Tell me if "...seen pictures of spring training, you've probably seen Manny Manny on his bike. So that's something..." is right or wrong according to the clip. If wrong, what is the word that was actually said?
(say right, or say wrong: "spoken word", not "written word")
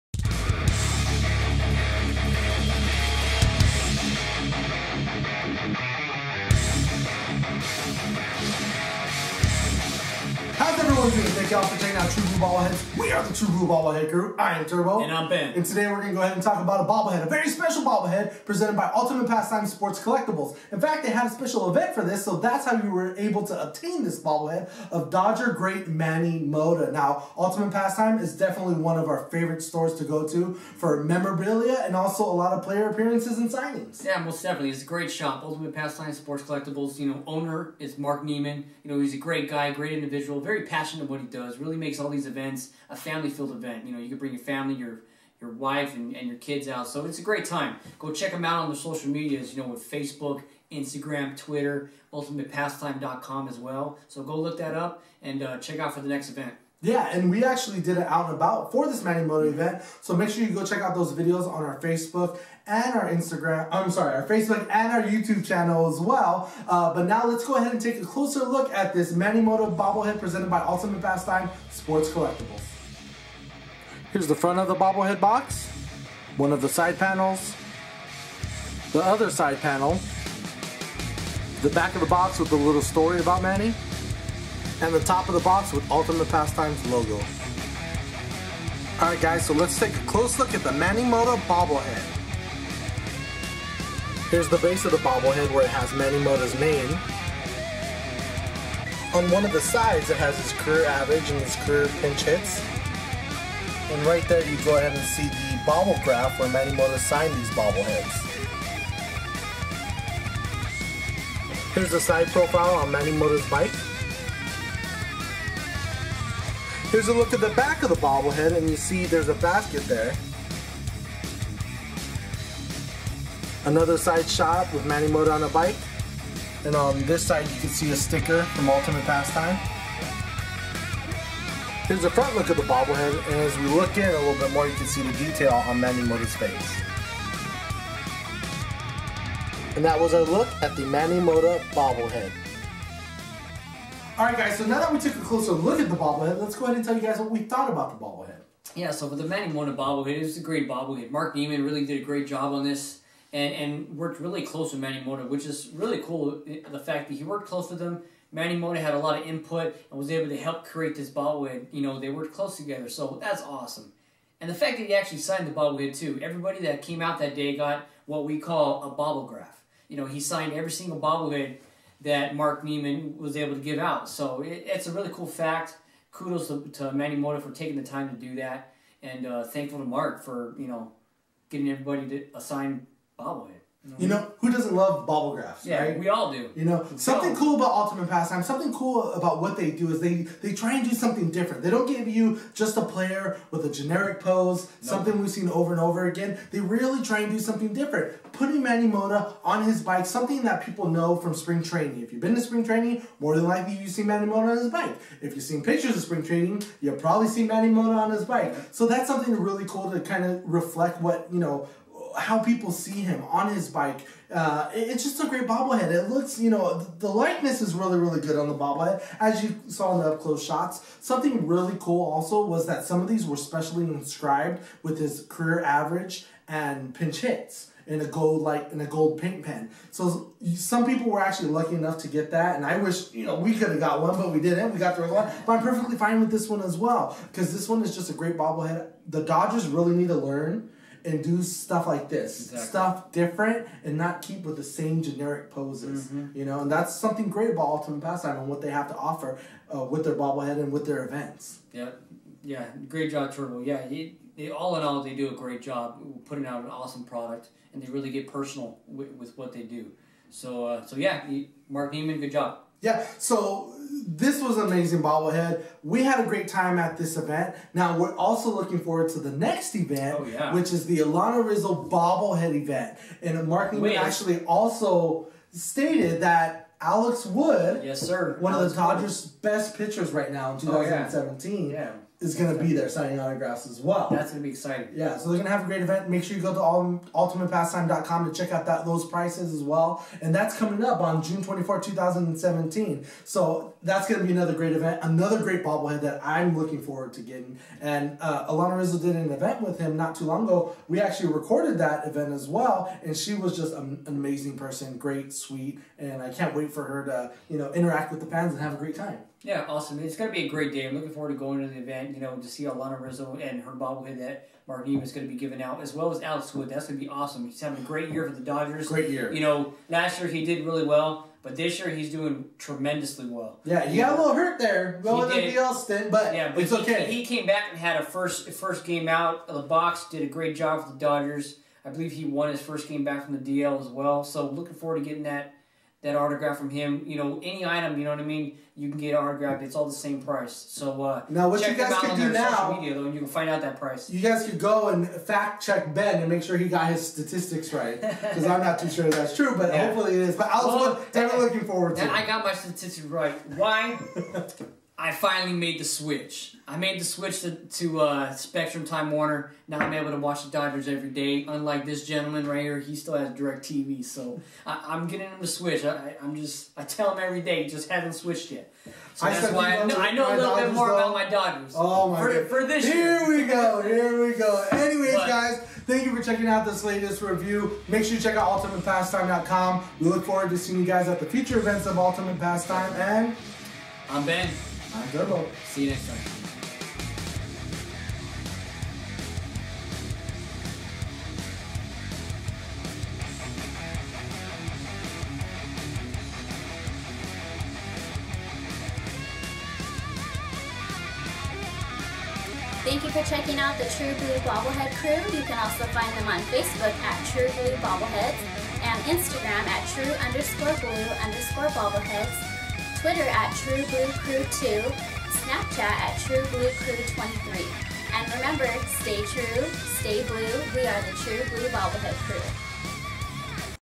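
wrong: "Mota", not "Manny".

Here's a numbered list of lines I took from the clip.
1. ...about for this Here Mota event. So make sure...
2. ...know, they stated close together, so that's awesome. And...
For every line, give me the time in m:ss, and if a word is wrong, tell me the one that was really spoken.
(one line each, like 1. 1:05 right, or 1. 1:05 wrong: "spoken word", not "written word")
1. 0:58 wrong: "Manny", not "Here"
2. 2:41 wrong: "worked", not "stated".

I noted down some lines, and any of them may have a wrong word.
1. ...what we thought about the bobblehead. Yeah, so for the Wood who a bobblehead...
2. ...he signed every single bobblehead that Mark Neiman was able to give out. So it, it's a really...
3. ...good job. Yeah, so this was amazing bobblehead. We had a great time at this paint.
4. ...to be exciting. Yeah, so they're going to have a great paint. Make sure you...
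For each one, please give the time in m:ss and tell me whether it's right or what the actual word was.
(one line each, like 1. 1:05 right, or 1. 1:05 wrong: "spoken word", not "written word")
1. 2:27 wrong: "Manny", not "Wood"
2. 2:50 right
3. 4:22 wrong: "event", not "paint"
4. 4:44 wrong: "event", not "paint".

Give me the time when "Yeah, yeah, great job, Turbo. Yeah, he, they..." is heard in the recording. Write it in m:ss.
4:11.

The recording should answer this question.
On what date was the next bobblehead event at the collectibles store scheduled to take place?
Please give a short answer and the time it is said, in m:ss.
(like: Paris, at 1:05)
June 24, 2017, at 4:51.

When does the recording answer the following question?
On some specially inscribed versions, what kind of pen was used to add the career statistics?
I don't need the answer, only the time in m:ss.
3:48.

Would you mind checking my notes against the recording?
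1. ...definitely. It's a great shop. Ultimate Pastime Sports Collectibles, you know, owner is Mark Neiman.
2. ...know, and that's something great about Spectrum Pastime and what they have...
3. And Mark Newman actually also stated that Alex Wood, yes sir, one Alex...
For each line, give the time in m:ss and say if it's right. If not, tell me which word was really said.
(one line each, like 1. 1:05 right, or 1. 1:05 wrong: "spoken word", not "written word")
1. 0:34 right
2. 4:06 wrong: "Ultimate", not "Spectrum"
3. 4:33 right.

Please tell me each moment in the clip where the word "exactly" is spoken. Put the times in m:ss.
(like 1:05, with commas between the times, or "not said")
4:02.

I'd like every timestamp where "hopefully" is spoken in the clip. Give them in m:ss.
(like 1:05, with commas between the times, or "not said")
5:49.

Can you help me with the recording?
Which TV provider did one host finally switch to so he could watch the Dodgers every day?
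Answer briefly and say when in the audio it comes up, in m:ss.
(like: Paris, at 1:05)
Spectrum Time Warner, at 5:58.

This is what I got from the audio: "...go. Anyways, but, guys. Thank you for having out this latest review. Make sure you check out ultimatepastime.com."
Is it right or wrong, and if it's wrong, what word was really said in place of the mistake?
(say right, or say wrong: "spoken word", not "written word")
wrong: "checking", not "having".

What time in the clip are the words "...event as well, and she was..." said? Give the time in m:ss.
5:02.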